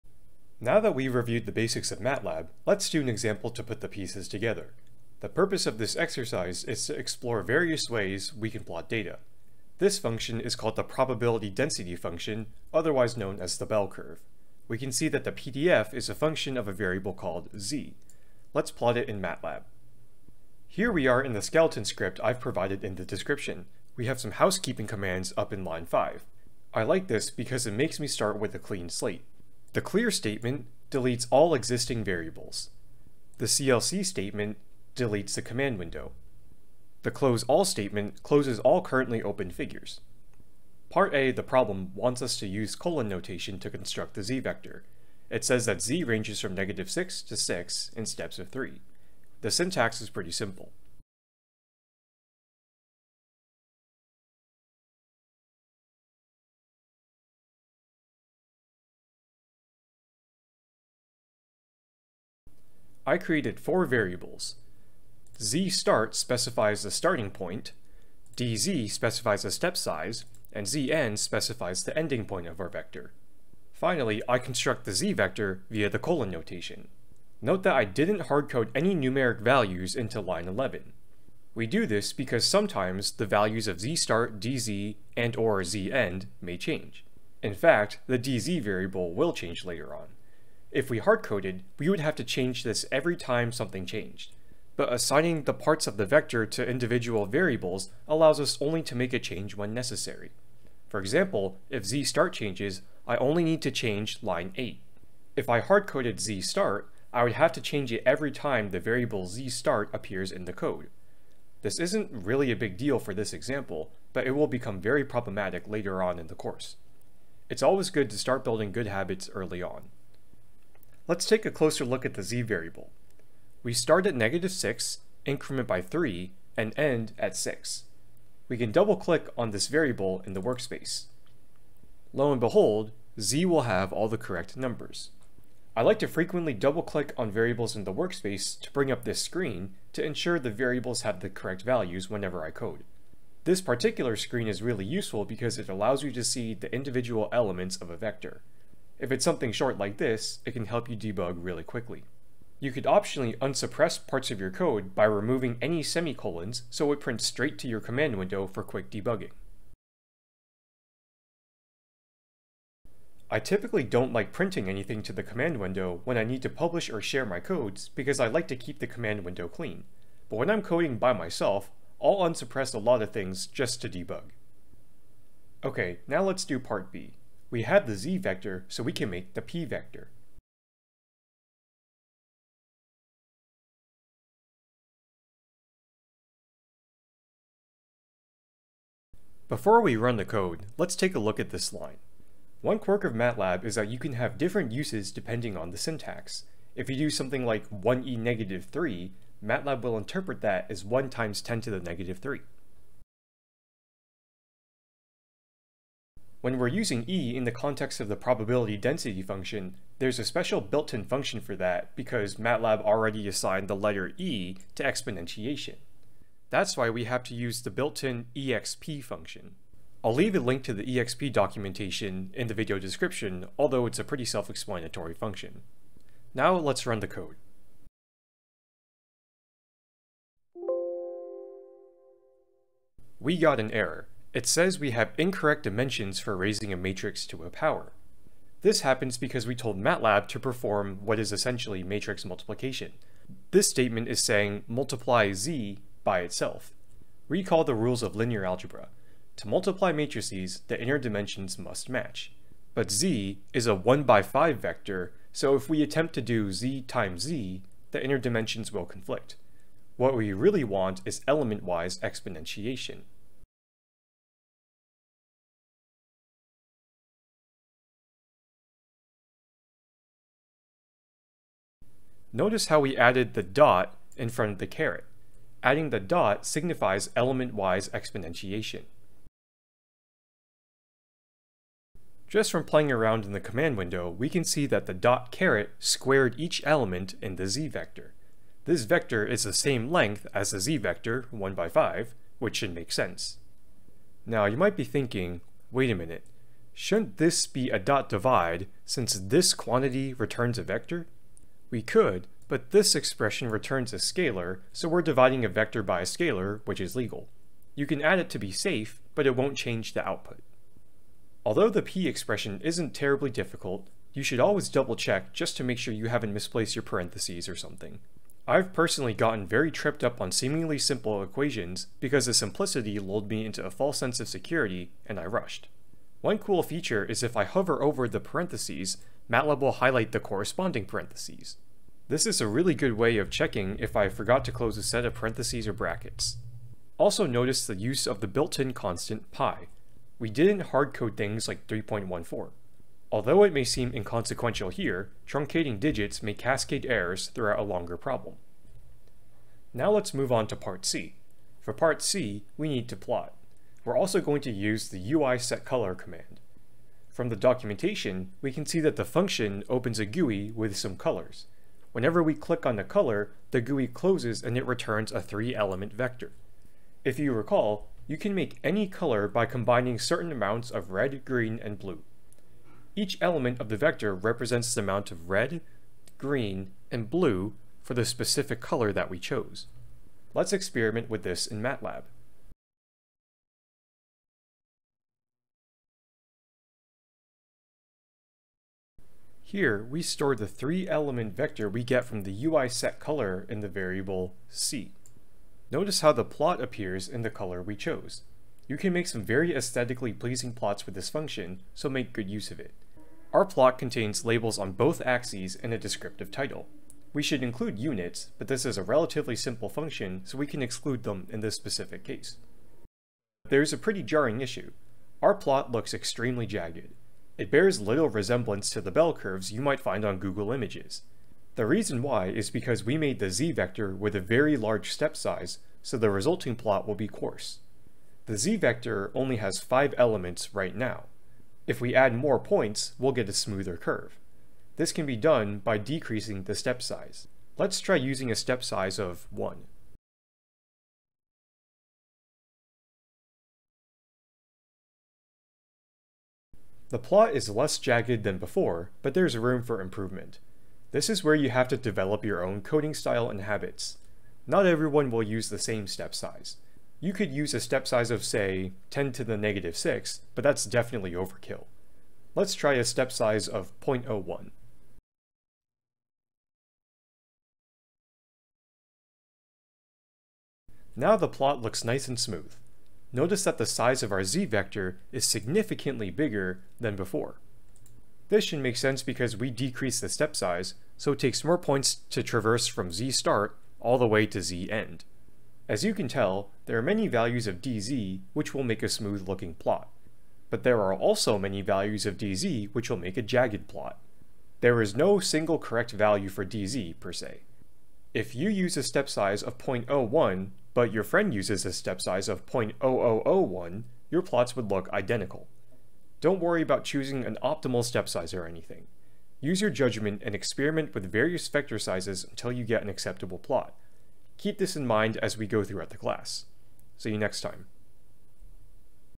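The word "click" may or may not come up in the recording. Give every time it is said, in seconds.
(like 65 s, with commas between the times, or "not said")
128 s, 136 s, 362 s.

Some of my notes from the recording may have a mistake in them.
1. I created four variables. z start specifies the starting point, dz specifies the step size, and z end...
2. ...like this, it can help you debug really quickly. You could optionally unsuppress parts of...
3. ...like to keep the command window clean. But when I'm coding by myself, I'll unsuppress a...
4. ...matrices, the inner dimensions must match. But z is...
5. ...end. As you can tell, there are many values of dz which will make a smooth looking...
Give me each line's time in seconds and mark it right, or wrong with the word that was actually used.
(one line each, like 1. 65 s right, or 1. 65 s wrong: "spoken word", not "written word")
1. 63 s right
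2. 149 s right
3. 168 s right
4. 249 s right
5. 484 s right.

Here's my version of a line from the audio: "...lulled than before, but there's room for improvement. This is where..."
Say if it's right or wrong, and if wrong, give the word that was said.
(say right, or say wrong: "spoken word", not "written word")
wrong: "jagged", not "lulled".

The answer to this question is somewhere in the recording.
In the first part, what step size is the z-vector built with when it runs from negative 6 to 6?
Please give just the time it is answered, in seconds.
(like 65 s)
48 s.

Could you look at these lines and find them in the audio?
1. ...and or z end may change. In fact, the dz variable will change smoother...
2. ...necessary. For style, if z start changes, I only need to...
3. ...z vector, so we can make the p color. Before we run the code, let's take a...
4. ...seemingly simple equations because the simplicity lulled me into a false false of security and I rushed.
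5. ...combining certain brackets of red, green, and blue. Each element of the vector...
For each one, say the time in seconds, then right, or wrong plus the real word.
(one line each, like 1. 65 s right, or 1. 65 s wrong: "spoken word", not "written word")
1. 85 s wrong: "later", not "smoother"
2. 99 s wrong: "example", not "style"
3. 177 s wrong: "vector", not "color"
4. 320 s wrong: "sense", not "false"
5. 369 s wrong: "amounts", not "brackets".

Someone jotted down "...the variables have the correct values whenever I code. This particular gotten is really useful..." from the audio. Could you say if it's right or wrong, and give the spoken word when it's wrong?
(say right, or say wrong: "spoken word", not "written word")
wrong: "screen", not "gotten".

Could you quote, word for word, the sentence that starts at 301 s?
We could, but this expression returns a scalar, so we're dividing a vector by a scalar, which is legal.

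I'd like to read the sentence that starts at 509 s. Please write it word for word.
Use your judgment and experiment with various vector sizes until you get an acceptable plot.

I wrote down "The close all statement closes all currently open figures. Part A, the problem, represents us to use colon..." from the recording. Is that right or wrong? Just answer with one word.
wrong.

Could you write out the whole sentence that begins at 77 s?
Note that I didn't hardcode any numeric values into line 11.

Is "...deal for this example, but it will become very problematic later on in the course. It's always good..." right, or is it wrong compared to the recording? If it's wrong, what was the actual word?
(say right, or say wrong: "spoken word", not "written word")
right.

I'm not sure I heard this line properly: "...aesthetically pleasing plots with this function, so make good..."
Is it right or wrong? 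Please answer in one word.
right.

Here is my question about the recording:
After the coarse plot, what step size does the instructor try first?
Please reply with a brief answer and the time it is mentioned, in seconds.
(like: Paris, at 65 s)
1, at 438 s.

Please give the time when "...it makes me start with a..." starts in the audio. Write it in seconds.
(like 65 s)
27 s.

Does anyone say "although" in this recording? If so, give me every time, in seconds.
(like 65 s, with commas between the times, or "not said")
223 s, 311 s, 343 s.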